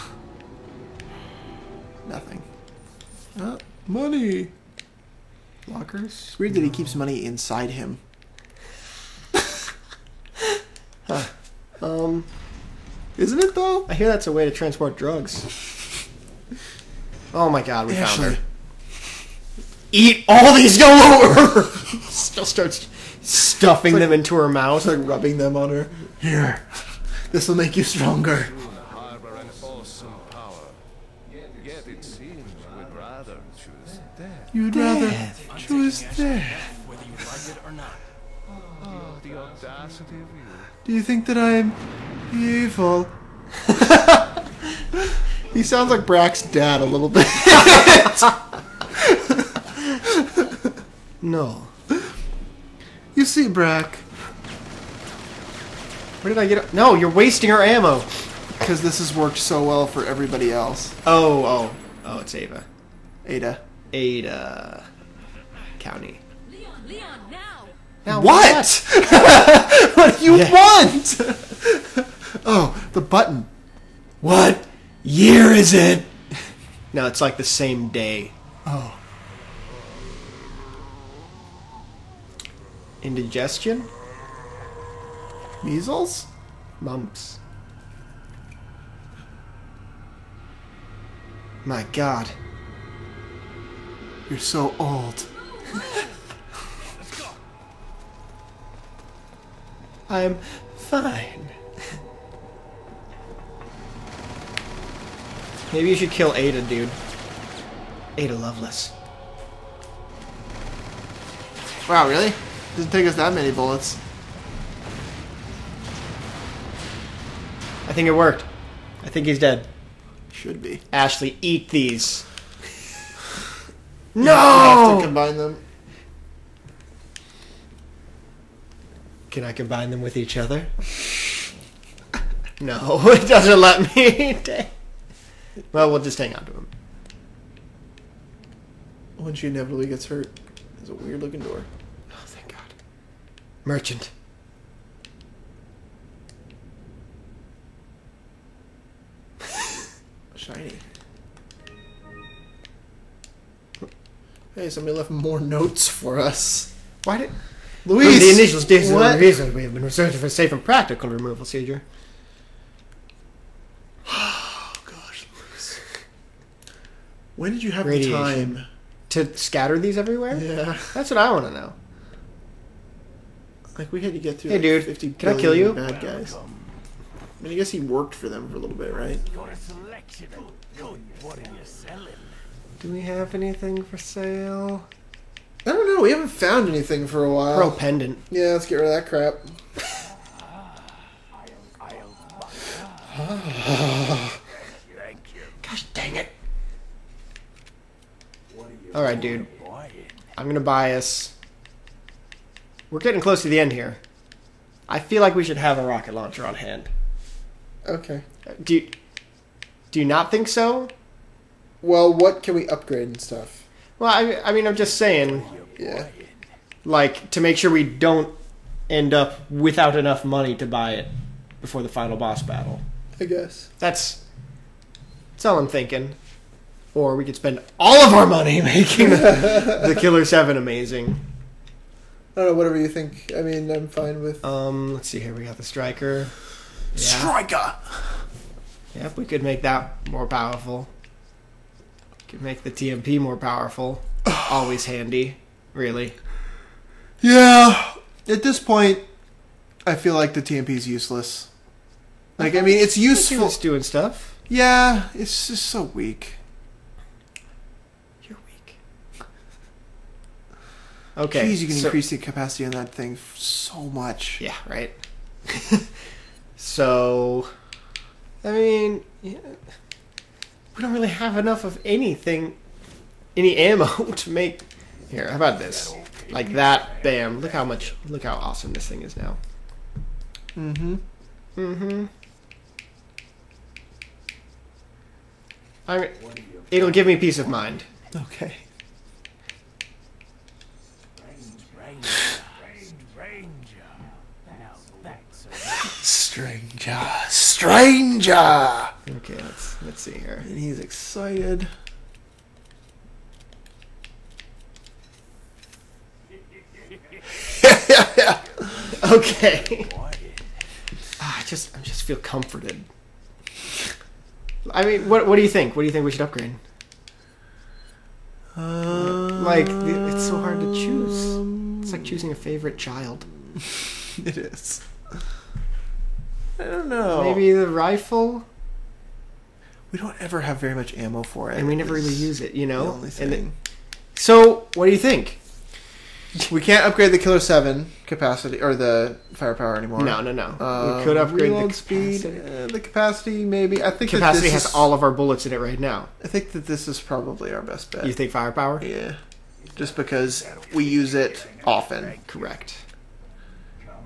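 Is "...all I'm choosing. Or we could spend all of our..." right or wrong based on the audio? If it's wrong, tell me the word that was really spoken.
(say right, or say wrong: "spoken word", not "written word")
wrong: "thinking", not "choosing".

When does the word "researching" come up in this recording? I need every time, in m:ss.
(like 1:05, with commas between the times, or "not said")
2:39.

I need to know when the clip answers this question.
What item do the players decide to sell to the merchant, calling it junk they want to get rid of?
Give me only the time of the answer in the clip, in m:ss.
3:07.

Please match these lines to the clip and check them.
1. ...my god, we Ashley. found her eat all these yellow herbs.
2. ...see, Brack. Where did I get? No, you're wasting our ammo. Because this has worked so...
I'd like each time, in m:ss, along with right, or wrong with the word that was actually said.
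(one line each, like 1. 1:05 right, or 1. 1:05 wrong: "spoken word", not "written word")
1. 0:17 right
2. 0:53 right.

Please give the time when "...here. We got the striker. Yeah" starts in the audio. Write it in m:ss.
3:55.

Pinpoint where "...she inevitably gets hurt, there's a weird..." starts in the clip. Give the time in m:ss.
2:19.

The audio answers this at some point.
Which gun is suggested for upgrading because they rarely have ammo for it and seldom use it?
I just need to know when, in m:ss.
5:27.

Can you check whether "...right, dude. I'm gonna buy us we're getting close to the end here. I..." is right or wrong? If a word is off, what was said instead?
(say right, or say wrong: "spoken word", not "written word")
right.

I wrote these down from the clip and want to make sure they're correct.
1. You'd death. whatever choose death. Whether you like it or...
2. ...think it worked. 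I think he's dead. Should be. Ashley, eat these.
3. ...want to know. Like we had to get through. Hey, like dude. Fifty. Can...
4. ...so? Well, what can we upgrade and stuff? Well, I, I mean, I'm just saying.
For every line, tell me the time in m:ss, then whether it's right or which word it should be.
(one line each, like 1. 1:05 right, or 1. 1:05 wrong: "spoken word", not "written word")
1. 0:34 wrong: "rather", not "whatever"
2. 1:57 right
3. 2:51 right
4. 3:30 right.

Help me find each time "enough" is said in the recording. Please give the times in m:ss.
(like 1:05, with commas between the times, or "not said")
3:39, 4:31.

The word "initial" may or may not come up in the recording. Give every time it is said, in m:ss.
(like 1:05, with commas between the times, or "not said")
2:38.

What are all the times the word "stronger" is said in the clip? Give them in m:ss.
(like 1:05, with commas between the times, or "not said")
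0:27.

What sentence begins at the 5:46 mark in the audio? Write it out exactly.
I think that this is probably our best bet.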